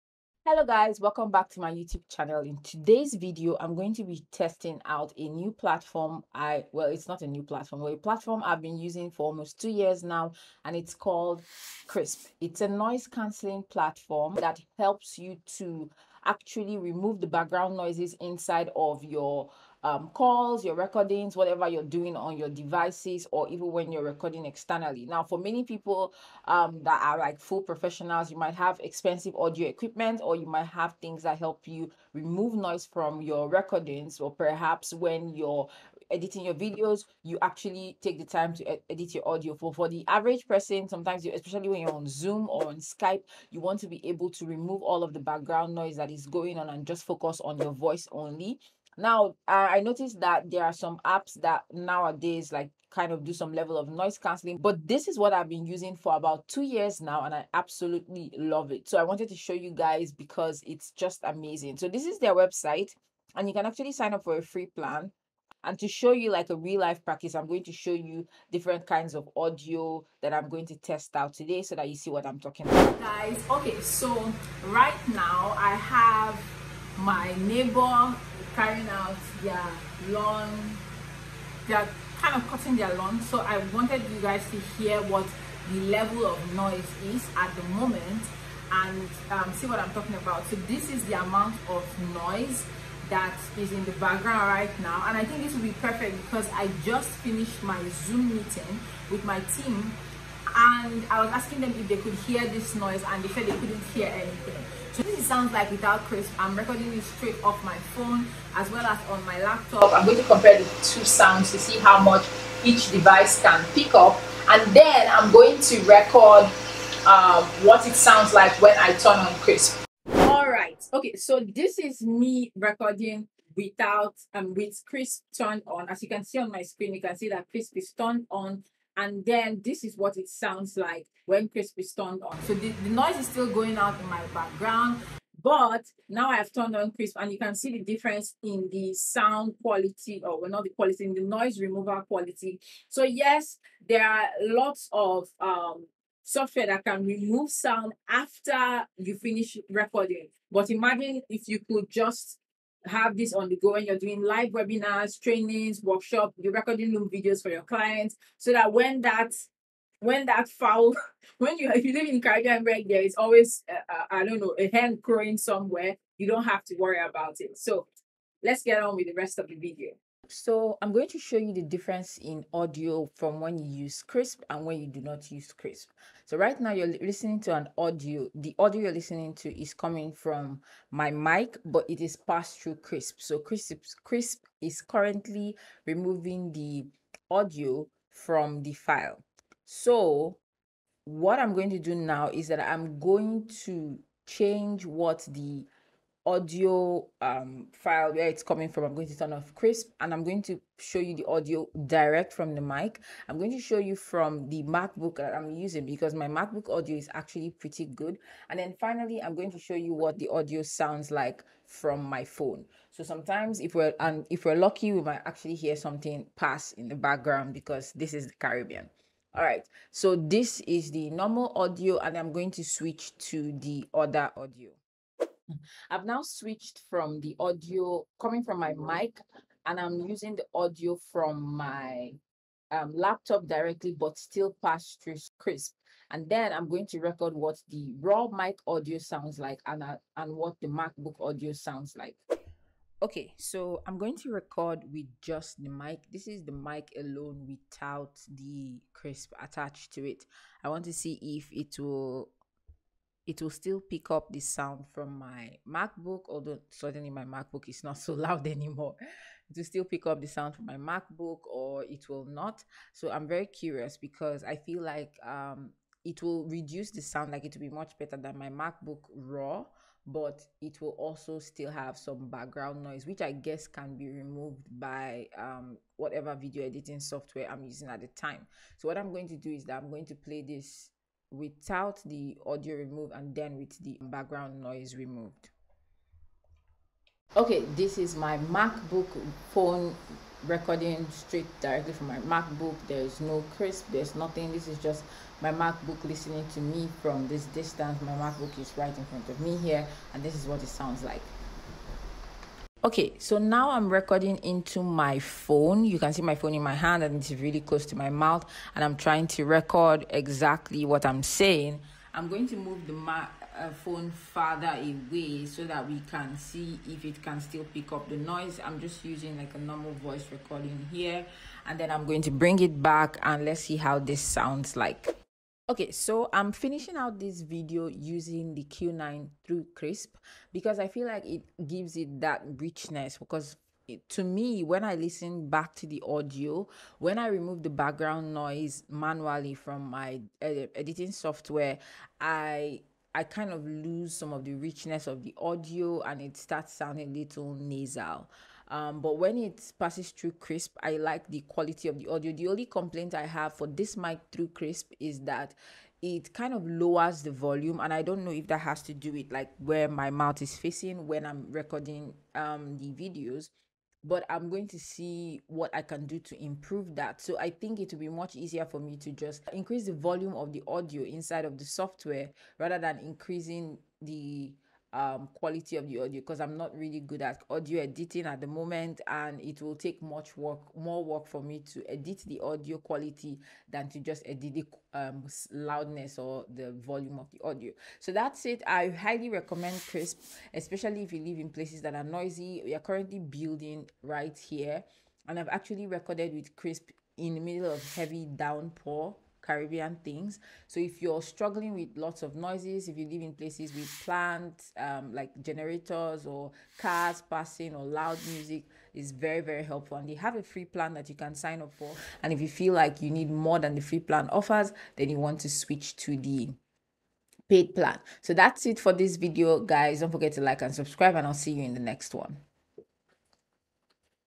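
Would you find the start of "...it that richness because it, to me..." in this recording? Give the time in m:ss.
5:31.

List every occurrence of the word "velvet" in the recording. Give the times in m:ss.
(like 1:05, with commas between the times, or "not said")
not said.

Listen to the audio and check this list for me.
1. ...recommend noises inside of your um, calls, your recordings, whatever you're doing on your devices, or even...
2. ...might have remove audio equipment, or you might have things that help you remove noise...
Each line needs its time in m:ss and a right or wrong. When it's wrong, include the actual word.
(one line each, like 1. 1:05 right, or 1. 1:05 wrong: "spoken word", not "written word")
1. 0:17 wrong: "background", not "recommend"
2. 0:28 wrong: "expensive", not "remove".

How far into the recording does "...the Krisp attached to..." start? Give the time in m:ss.
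4:08.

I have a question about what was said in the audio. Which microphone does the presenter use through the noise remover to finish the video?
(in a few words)
Q9.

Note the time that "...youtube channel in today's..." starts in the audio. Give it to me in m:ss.
0:01.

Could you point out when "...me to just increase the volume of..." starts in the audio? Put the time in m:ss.
6:08.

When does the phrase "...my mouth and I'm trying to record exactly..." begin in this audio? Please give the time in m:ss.
5:07.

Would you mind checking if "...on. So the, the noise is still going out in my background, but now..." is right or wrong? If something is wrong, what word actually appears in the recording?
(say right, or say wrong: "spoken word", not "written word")
right.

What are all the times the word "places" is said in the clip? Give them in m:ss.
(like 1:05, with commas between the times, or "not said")
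6:31, 6:43.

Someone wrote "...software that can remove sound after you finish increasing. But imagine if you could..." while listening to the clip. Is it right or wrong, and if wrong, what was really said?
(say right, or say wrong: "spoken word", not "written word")
wrong: "recording", not "increasing".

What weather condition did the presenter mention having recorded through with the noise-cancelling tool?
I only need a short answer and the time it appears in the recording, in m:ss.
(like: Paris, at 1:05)
heavy downpour, at 6:37.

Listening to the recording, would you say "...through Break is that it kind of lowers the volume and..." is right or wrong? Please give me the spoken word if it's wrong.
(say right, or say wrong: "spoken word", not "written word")
wrong: "Krisp", not "Break".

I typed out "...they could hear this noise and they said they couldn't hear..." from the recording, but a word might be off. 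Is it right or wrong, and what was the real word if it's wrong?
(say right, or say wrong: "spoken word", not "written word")
right.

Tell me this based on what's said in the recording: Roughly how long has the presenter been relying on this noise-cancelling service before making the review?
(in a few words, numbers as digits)
almost two years.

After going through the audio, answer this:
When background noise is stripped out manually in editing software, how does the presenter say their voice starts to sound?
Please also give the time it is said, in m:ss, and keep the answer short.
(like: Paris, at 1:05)
nasal, at 5:47.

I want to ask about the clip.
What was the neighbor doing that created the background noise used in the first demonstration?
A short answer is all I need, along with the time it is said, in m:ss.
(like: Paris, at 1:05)
cutting their lawn, at 1:22.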